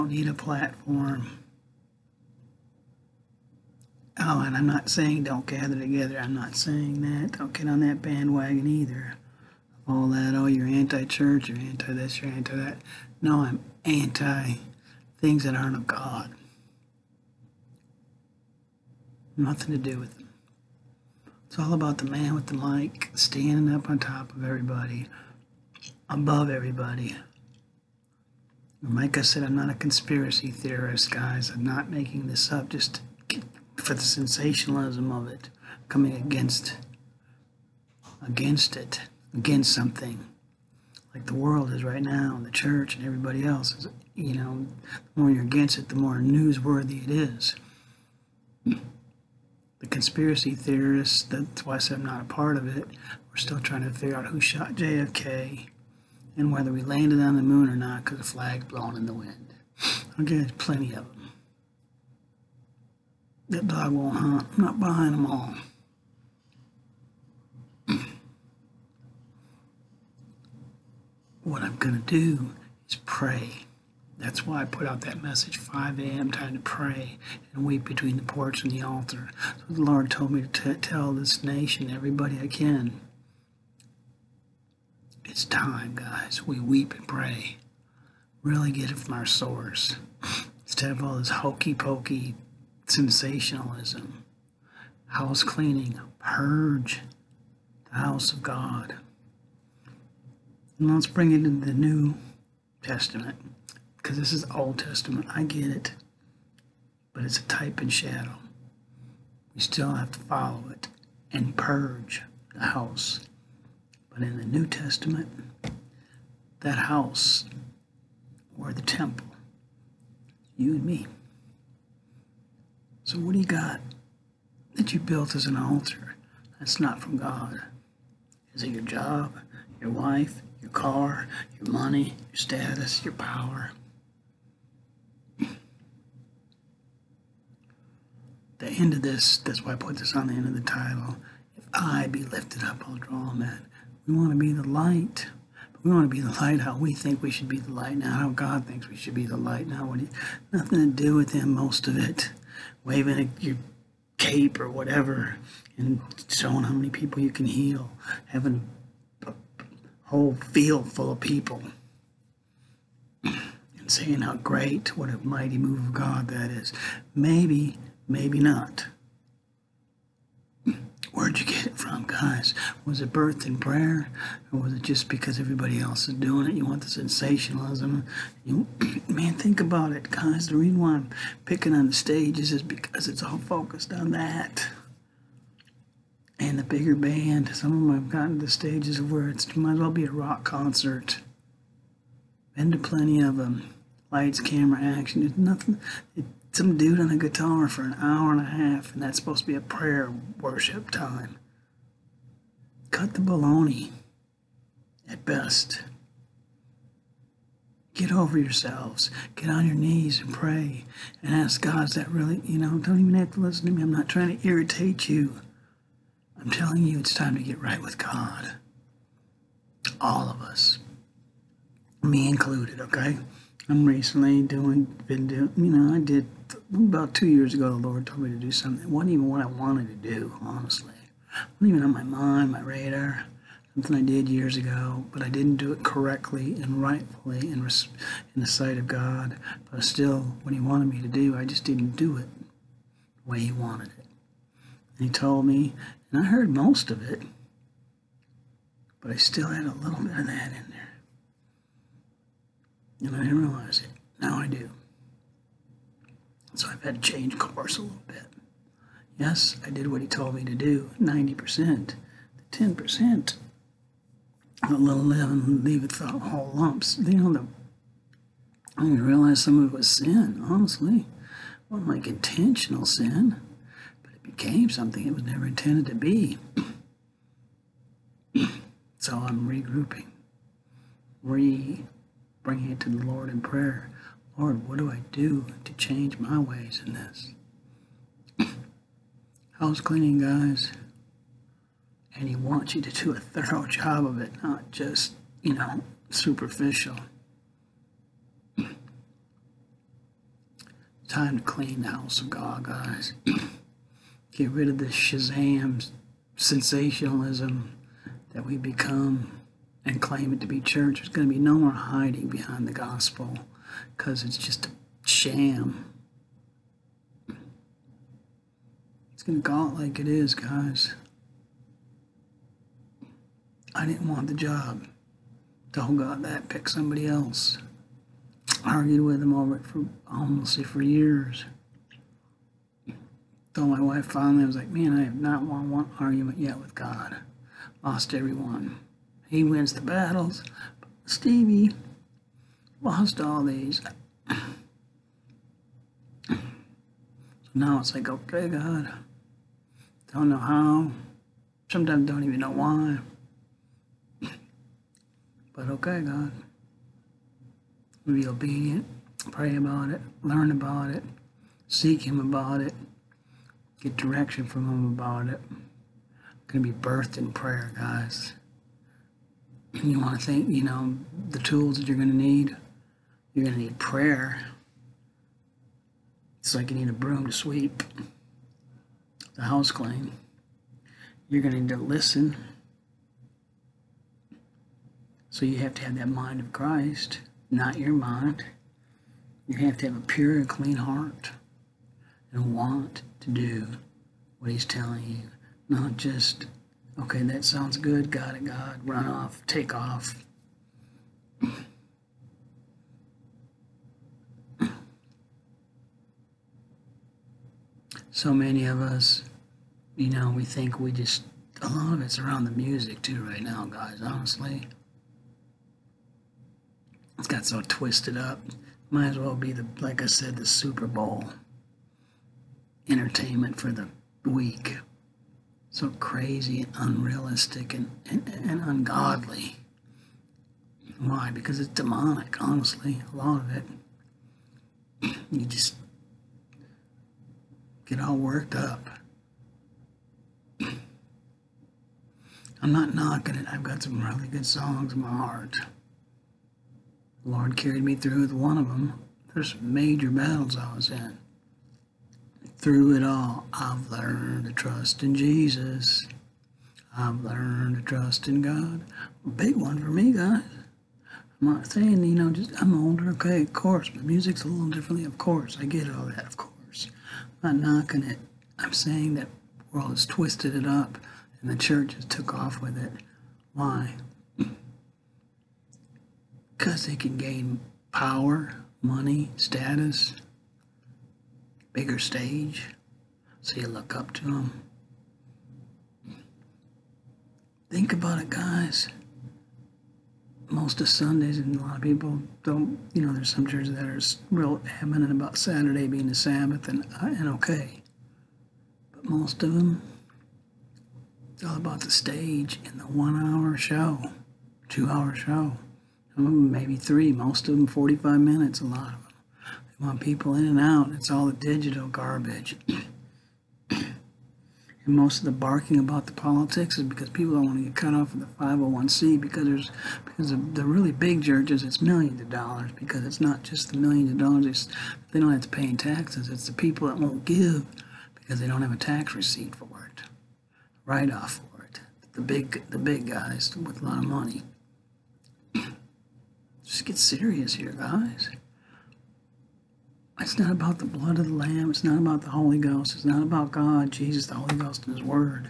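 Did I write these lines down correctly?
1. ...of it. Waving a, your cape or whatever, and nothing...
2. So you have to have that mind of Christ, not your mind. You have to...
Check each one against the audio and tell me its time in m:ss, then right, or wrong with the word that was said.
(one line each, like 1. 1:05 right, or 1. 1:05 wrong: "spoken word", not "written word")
1. 2:31 wrong: "showing", not "nothing"
2. 6:25 right.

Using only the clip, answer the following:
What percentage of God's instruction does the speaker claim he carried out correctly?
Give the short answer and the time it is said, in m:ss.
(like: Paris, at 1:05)
90%, at 4:21.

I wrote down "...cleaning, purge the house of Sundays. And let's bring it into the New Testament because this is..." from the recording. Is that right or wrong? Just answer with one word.
wrong.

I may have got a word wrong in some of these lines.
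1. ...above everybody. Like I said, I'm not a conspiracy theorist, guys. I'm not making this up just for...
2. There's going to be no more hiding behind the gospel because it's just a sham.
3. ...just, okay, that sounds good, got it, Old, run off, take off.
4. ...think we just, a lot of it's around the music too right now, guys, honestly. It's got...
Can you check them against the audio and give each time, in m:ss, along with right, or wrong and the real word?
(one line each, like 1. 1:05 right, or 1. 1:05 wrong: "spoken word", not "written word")
1. 0:26 right
2. 5:10 right
3. 6:35 wrong: "God", not "Old"
4. 6:50 right.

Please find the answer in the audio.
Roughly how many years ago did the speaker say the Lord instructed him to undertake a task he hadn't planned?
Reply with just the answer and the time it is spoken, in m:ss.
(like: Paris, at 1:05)
2, at 3:47.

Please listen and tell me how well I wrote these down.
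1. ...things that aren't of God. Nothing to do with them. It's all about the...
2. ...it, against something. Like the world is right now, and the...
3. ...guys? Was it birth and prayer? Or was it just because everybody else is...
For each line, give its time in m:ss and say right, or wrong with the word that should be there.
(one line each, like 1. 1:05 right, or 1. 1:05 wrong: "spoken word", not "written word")
1. 0:15 right
2. 0:38 right
3. 2:52 right.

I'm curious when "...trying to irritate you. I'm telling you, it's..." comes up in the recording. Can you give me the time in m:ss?
3:34.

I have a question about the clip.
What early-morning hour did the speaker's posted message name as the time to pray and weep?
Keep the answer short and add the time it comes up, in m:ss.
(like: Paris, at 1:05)
5 a.m., at 1:15.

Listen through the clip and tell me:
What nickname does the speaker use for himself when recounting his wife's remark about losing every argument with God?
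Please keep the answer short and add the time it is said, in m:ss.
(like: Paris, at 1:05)
Stevie, at 5:41.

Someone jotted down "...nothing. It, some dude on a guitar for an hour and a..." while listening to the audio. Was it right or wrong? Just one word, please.
right.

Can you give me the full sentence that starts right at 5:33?
Though my wife finally was like, man, I have not won one argument yet with God.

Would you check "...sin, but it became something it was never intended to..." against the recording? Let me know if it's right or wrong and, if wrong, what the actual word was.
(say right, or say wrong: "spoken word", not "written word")
right.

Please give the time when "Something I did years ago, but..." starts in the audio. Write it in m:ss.
3:53.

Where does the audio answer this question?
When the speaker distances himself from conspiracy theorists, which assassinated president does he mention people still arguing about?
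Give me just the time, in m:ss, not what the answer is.
0:54.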